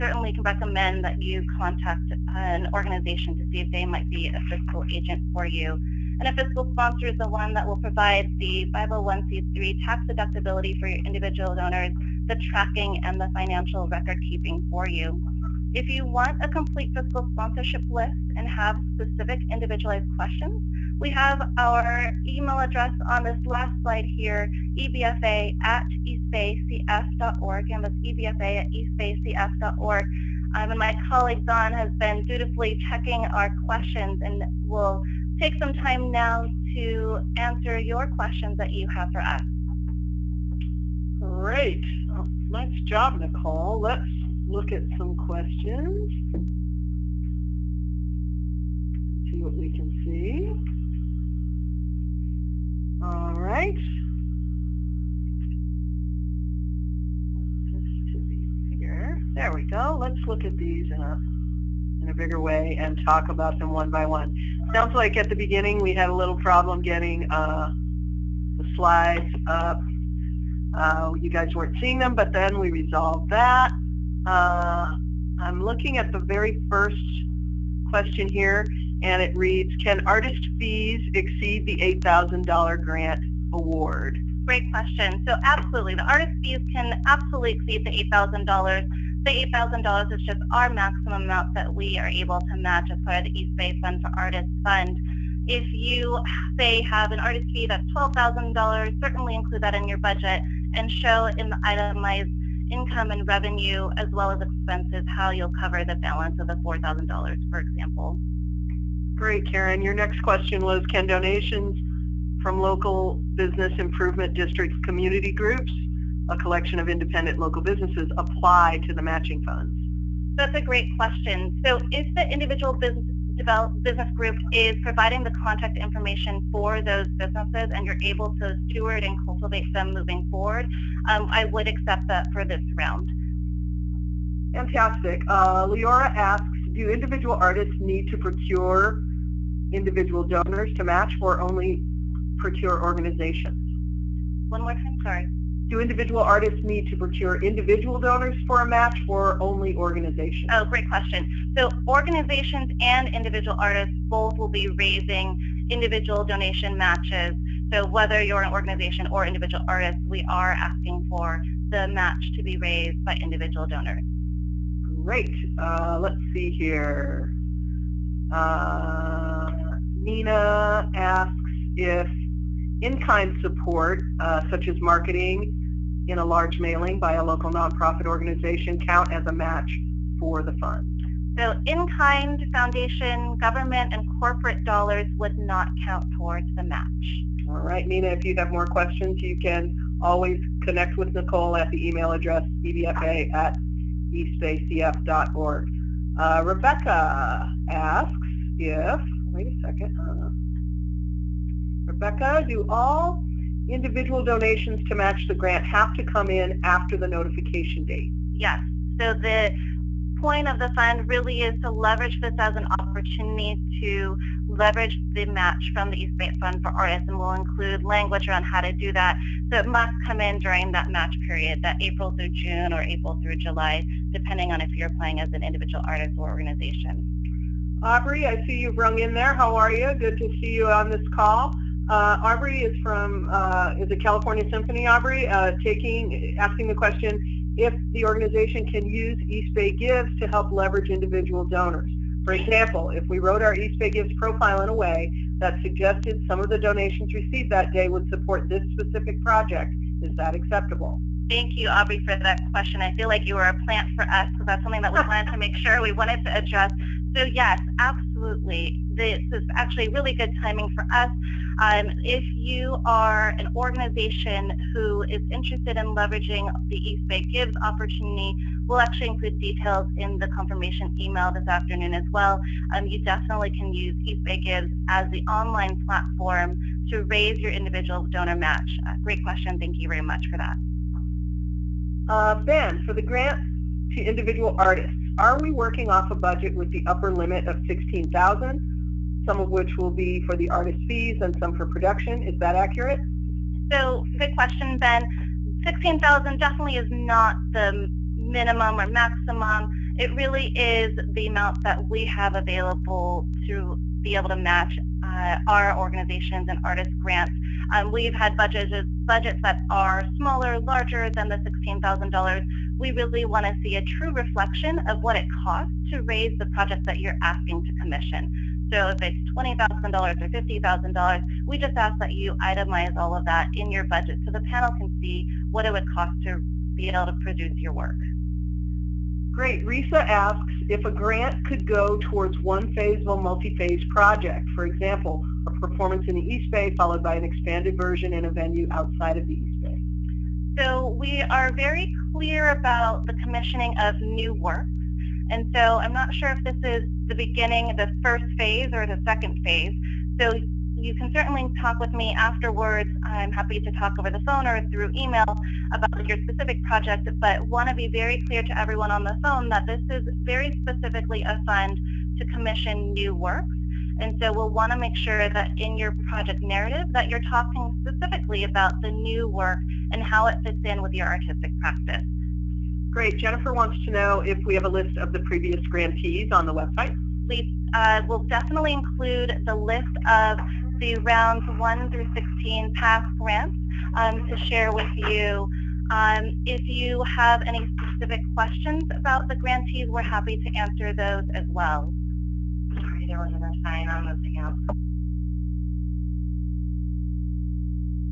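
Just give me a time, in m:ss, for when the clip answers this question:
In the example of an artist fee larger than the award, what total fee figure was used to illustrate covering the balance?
1:37.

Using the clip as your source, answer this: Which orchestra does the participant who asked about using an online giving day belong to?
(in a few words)
California Symphony.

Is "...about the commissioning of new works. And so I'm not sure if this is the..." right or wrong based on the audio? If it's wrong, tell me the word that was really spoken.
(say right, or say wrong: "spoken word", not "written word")
right.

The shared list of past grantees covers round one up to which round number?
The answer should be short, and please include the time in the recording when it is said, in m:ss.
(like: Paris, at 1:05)
16, at 6:22.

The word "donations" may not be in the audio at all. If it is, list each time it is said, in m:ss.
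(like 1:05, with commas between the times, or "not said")
1:51, 2:36, 3:24, 4:06.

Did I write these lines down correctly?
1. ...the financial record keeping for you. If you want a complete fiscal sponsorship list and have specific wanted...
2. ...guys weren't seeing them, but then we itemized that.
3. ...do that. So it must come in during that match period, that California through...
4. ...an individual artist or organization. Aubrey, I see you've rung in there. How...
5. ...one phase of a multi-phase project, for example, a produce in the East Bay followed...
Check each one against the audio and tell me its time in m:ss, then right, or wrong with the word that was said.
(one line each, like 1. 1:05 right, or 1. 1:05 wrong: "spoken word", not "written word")
1. 0:13 wrong: "individualized", not "wanted"
2. 1:11 wrong: "resolved", not "itemized"
3. 3:38 wrong: "April", not "California"
4. 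3:45 right
5. 5:32 wrong: "performance", not "produce".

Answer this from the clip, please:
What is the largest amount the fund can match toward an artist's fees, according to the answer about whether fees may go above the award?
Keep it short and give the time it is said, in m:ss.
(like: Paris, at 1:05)
$8,000, at 1:29.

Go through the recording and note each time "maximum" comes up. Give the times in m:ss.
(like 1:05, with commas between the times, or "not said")
1:30, 4:58.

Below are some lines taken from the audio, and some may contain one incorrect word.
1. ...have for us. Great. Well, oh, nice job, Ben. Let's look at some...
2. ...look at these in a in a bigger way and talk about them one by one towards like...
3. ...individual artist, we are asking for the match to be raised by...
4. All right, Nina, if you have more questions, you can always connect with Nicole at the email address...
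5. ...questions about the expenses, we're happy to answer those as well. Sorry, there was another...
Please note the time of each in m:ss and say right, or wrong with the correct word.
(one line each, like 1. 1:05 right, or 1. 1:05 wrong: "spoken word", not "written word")
1. 0:38 wrong: "Nicole", not "Ben"
2. 1:00 wrong: "sounds", not "towards"
3. 2:39 right
4. 3:07 right
5. 6:28 wrong: "grantees", not "expenses".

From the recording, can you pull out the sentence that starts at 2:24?
One more time, sorry do individual artists need to procure individual donors for a match or only organizations?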